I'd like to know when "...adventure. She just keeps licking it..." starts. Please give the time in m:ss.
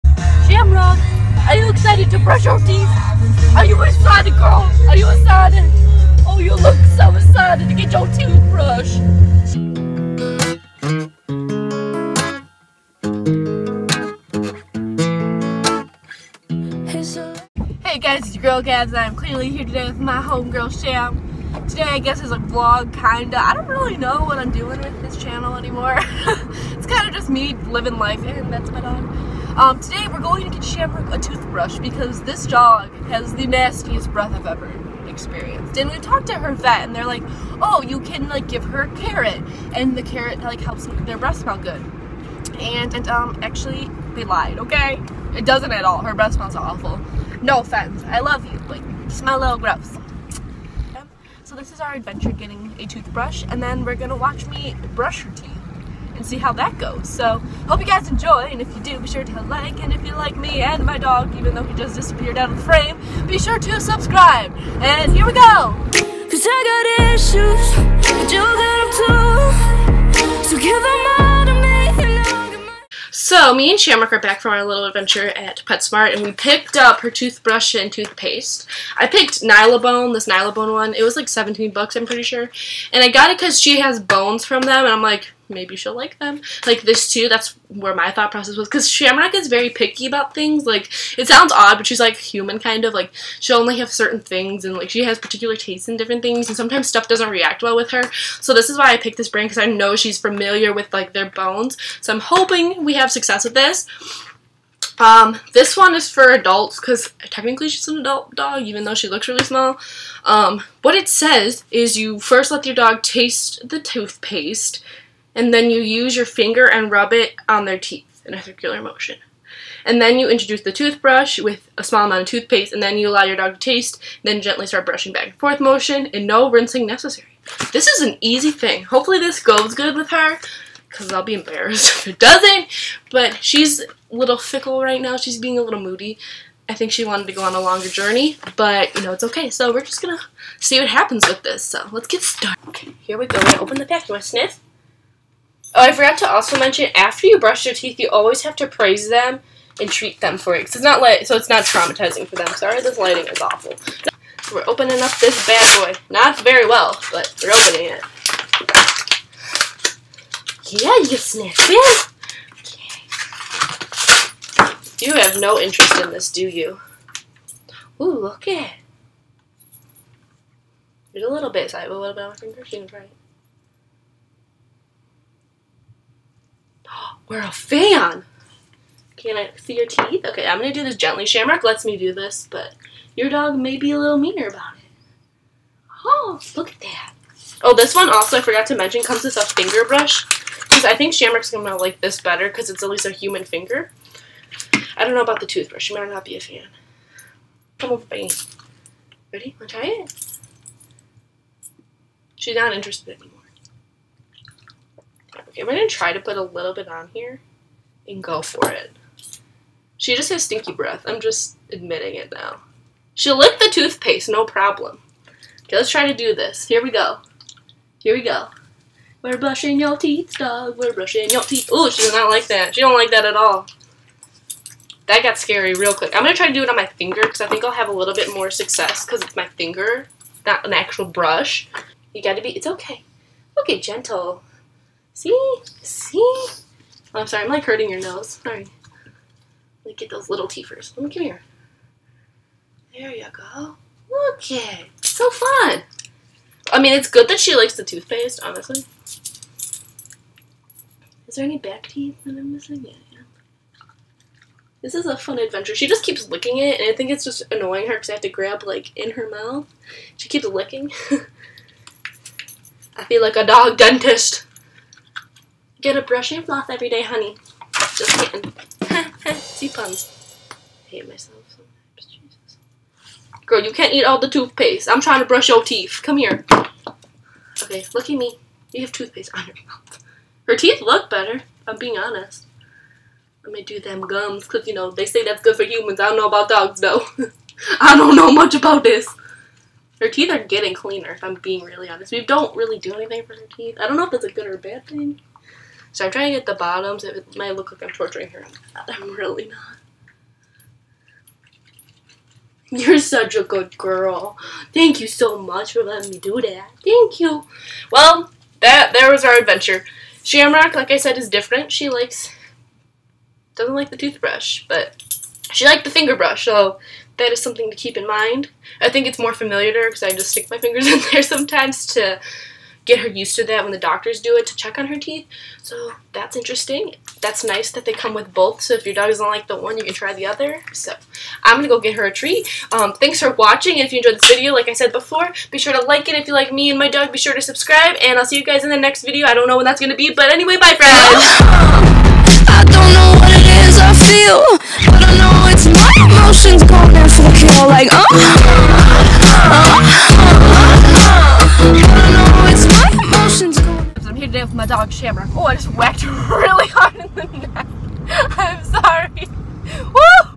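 4:15.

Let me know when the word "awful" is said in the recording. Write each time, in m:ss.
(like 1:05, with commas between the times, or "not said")
0:46, 2:33.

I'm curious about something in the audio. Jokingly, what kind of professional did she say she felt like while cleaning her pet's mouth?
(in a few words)
dog dentist.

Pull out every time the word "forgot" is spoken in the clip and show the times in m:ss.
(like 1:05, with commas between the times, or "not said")
2:25, 3:08.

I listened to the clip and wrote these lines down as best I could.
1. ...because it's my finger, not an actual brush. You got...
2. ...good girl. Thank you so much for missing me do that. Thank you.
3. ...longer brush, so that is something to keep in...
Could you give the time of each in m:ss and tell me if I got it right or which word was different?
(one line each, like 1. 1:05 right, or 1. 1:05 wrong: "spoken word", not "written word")
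1. 3:49 right
2. 5:03 wrong: "letting", not "missing"
3. 5:15 wrong: "finger", not "longer".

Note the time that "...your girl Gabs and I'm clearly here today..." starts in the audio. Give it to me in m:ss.
0:18.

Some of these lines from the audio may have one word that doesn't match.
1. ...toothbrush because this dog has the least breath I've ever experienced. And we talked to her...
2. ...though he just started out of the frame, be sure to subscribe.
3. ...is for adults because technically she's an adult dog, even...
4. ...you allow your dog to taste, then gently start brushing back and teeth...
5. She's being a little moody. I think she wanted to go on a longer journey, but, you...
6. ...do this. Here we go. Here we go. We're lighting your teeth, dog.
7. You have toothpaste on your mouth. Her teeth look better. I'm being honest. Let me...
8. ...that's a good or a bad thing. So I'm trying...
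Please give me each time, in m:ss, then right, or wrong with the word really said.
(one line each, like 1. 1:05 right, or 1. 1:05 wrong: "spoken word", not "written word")
1. 0:31 wrong: "nastiest", not "least"
2. 1:01 wrong: "disappeared", not "started"
3. 1:45 right
4. 2:02 wrong: "forth", not "teeth"
5. 2:15 right
6. 3:36 wrong: "brushing", not "lighting"
7. 4:38 right
8. 4:54 right.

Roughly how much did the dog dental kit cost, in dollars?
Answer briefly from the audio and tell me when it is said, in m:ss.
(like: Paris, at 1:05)
17, at 1:21.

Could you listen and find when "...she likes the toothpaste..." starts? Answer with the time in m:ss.
4:07.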